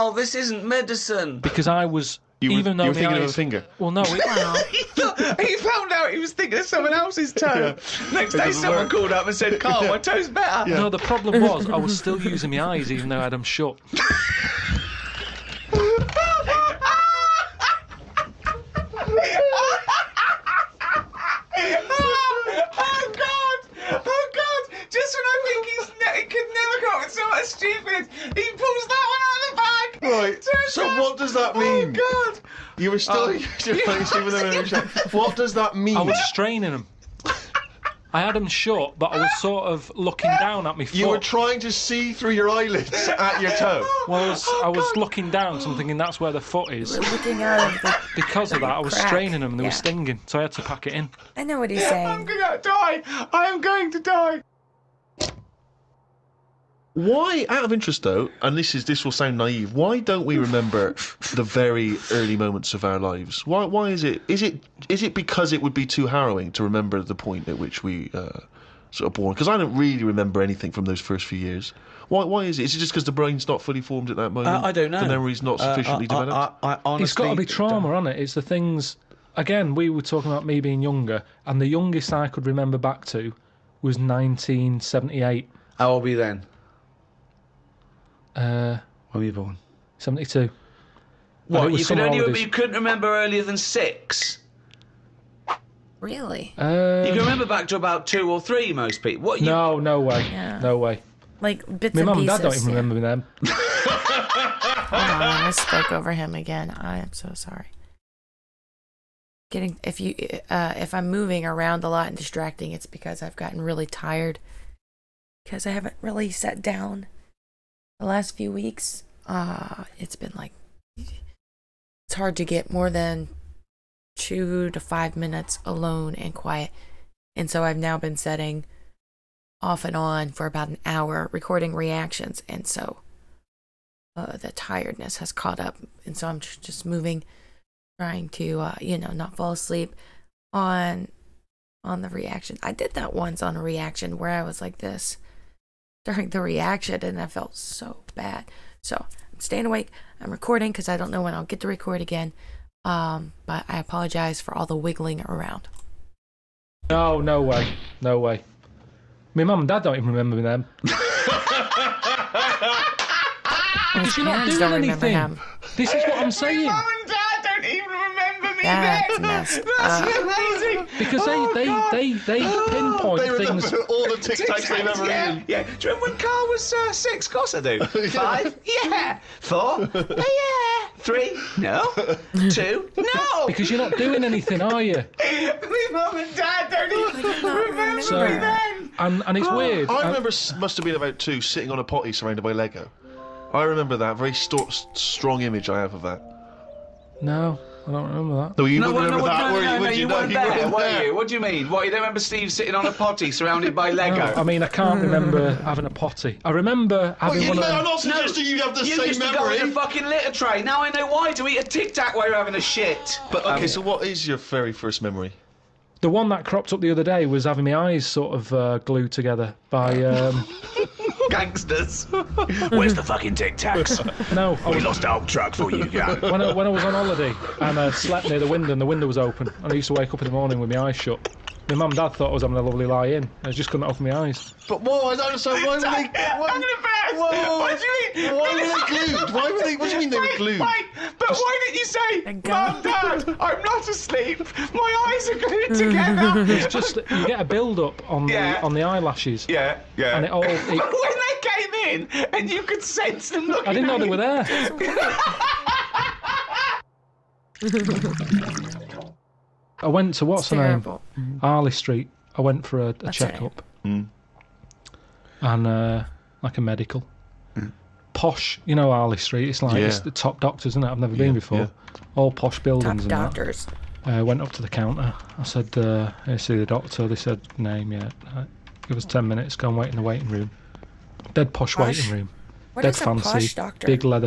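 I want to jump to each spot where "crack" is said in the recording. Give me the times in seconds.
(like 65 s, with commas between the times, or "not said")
48 s.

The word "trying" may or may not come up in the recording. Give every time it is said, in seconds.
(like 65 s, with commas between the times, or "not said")
41 s, 138 s.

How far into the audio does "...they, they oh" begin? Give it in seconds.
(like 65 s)
172 s.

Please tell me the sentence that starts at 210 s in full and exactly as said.
Now I know why, to eat a Tic Tac while you're having a shit.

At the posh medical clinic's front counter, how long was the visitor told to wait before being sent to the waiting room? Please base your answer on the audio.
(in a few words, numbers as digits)
10 minutes.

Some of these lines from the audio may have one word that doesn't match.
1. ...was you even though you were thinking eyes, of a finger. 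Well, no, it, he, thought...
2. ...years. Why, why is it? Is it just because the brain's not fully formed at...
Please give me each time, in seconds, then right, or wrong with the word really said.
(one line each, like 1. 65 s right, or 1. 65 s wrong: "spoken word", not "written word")
1. 1 s right
2. 71 s right.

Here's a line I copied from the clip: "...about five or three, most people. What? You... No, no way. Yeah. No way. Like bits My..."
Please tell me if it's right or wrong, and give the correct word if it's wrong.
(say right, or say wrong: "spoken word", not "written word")
wrong: "two", not "five".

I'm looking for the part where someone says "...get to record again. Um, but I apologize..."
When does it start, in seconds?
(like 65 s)
151 s.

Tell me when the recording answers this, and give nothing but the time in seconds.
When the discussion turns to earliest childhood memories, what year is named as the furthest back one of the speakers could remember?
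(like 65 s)
83 s.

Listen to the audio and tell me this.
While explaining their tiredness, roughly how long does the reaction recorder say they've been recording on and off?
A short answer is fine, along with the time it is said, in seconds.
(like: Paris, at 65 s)
about an hour, at 130 s.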